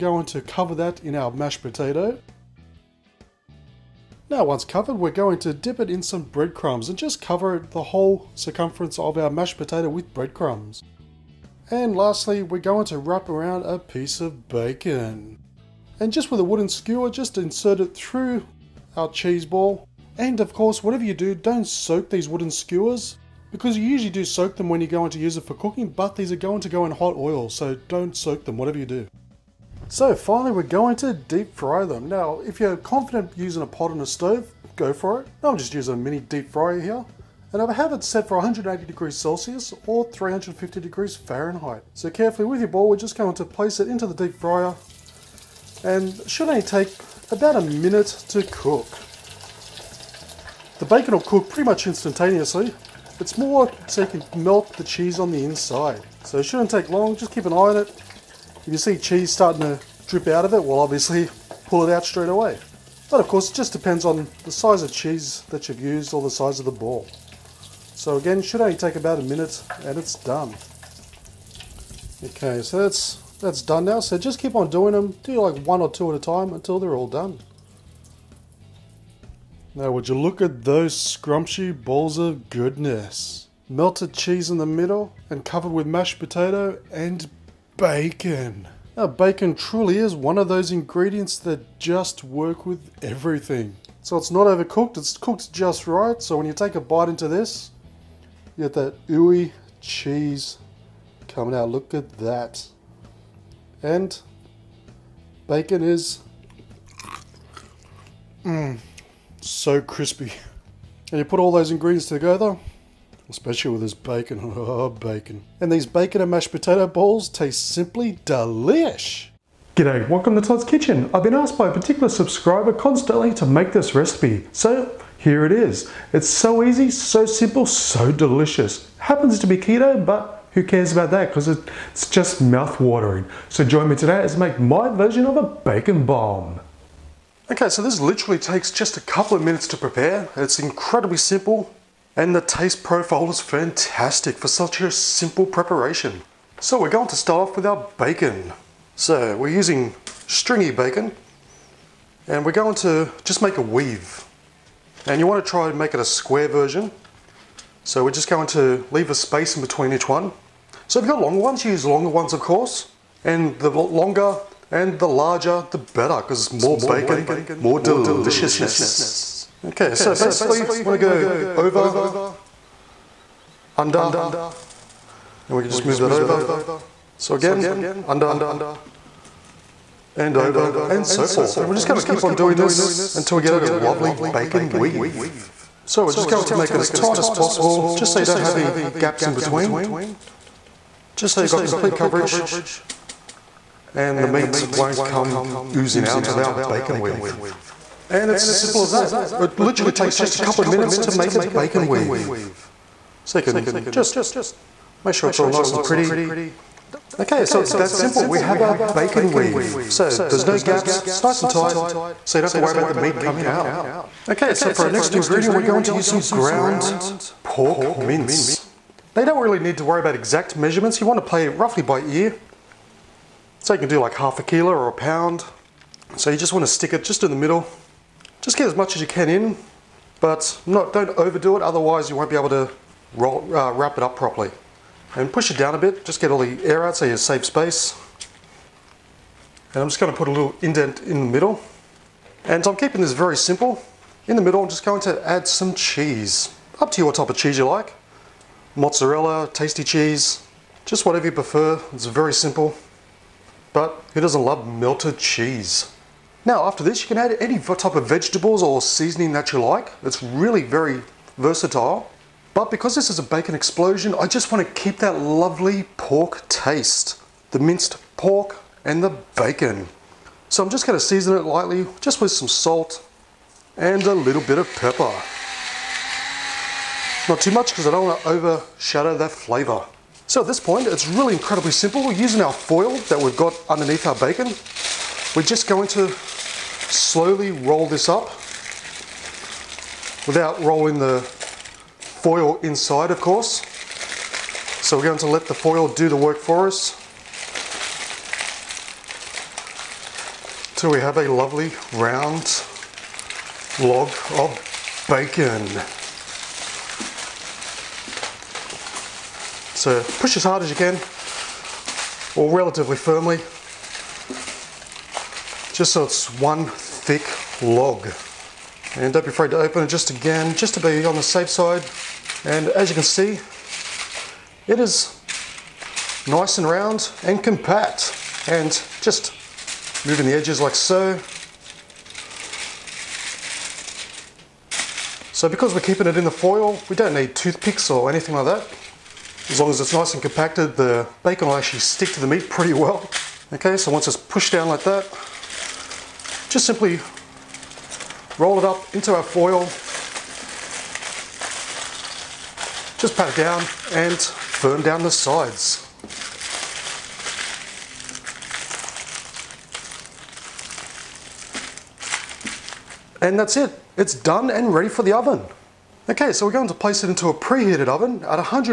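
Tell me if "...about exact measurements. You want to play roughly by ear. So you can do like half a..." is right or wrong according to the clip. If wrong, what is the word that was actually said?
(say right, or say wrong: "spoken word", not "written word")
right.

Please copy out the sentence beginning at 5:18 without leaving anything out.
And don't be afraid to open it just again, just to be on the safe side.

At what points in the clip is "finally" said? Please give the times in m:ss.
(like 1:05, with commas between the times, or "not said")
0:30.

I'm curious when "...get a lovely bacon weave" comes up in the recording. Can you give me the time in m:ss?
3:03.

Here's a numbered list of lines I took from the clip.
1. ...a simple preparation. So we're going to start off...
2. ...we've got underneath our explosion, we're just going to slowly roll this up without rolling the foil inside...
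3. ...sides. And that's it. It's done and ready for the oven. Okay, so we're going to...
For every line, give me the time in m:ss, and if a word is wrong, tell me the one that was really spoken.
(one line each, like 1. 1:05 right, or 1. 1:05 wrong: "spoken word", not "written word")
1. 2:24 right
2. 4:43 wrong: "bacon", not "explosion"
3. 5:55 right.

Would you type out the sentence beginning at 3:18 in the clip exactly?
And it's as simple as that.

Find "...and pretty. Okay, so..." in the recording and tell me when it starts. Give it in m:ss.
3:25.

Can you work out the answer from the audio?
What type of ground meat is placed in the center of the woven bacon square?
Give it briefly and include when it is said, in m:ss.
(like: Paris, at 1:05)
ground pork mince, at 3:36.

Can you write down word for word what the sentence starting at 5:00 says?
So we have a lovely round log of bacon.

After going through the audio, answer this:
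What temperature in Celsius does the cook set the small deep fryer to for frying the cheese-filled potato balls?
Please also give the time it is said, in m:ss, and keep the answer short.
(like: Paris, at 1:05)
180 degrees Celsius, at 0:38.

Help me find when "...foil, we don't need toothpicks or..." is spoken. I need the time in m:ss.
5:36.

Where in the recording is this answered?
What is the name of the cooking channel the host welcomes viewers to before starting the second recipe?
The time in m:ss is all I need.
2:00.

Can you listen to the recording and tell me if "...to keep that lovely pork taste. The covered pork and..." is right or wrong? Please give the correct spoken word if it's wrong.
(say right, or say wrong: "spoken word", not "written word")
wrong: "minced", not "covered".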